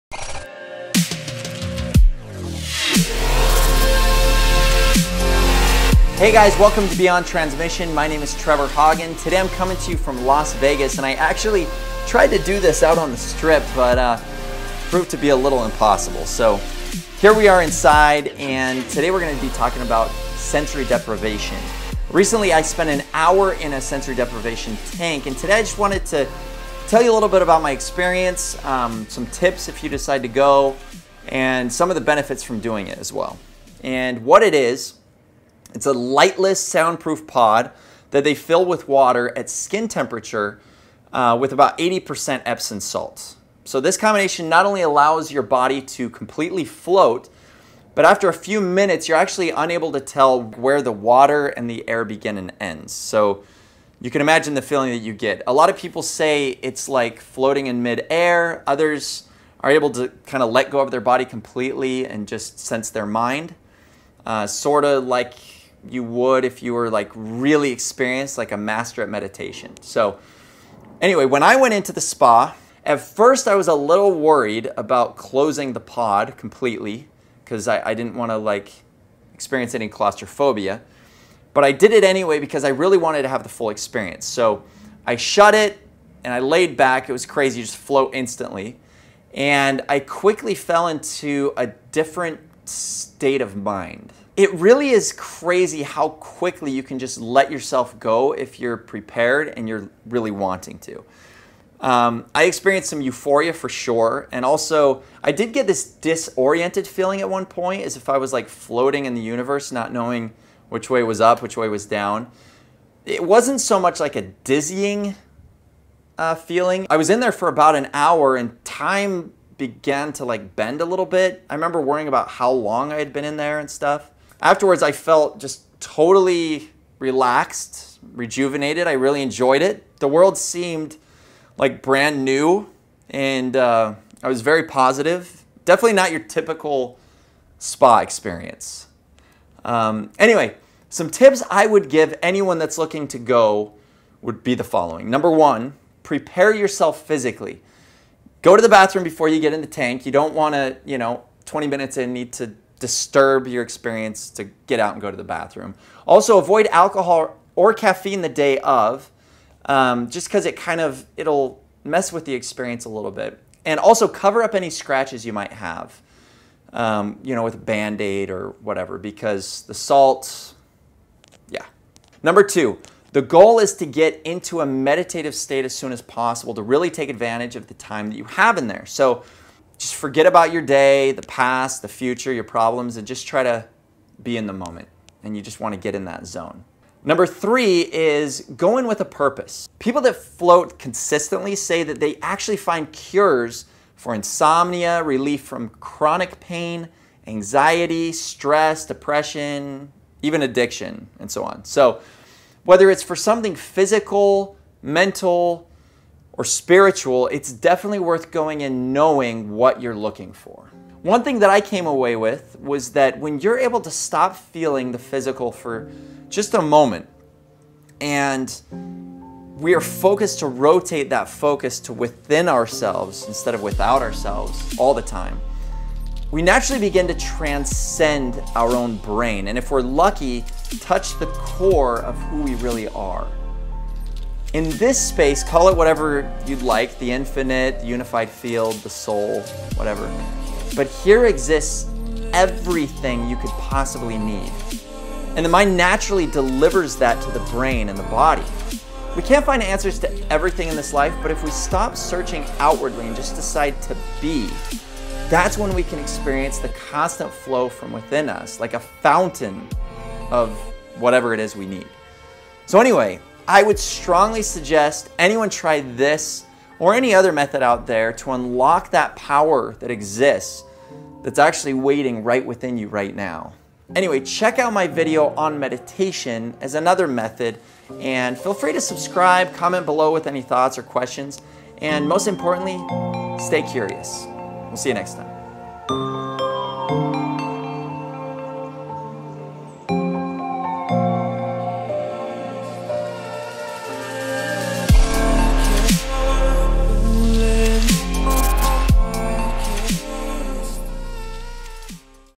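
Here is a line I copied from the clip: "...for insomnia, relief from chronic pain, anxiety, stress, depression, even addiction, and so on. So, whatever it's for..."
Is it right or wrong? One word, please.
wrong.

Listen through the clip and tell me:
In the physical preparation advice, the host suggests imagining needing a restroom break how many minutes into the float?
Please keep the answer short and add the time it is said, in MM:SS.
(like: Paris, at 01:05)
20, at 02:31.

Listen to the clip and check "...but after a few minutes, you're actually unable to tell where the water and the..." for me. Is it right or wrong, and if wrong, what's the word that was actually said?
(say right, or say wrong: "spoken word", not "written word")
right.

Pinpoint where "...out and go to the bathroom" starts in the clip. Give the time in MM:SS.
02:34.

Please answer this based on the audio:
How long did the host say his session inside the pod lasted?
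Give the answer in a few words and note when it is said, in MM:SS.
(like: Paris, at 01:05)
about an hour, at 01:57.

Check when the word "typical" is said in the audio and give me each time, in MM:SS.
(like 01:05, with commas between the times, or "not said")
02:16.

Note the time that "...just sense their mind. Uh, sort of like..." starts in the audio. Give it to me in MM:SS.
01:02.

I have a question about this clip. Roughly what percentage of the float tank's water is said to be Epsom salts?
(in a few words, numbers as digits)
80%.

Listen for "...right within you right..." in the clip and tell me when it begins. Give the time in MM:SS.
04:32.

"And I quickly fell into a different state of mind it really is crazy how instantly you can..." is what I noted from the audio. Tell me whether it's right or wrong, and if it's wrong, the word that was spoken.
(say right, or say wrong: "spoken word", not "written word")
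wrong: "quickly", not "instantly".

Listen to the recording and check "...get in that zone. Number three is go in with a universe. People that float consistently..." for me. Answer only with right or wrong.
wrong.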